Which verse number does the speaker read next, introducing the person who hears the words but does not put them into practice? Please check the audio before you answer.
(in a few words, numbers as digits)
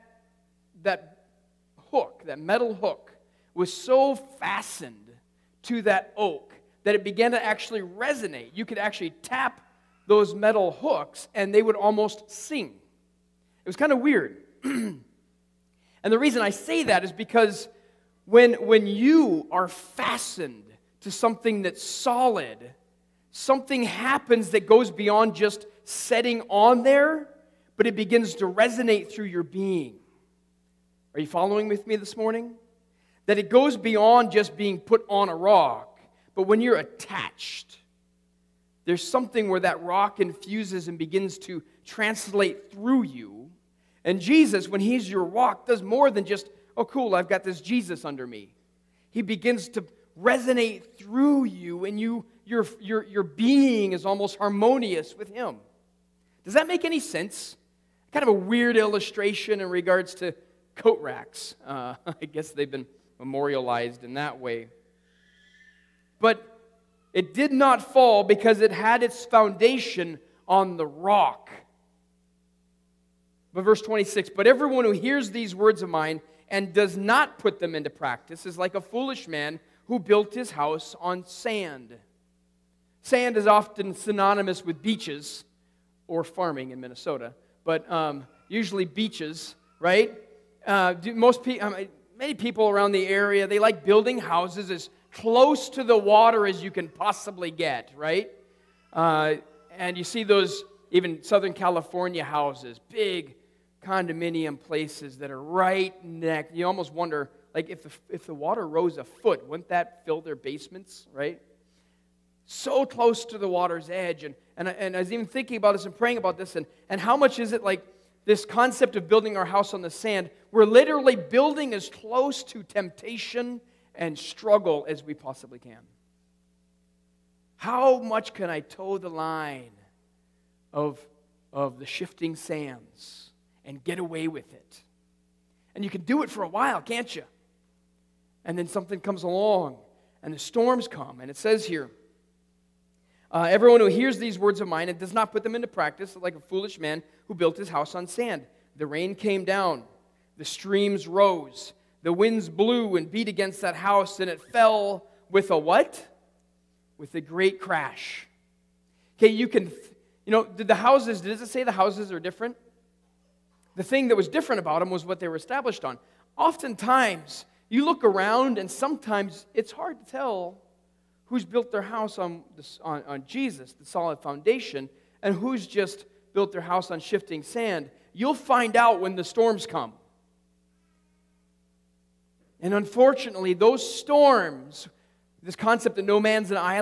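26.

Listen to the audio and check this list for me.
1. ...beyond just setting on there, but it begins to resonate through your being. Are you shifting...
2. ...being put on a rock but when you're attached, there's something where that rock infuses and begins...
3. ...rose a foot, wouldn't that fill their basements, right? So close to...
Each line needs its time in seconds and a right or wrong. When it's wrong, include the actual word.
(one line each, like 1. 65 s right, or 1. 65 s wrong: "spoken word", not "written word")
1. 24 s wrong: "following", not "shifting"
2. 34 s right
3. 108 s right.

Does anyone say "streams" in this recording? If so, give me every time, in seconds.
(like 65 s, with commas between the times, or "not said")
150 s.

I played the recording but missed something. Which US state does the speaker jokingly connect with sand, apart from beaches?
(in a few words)
Minnesota.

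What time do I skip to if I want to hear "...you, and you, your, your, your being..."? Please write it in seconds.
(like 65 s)
51 s.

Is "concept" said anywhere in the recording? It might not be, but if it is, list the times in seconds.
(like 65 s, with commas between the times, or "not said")
118 s, 185 s.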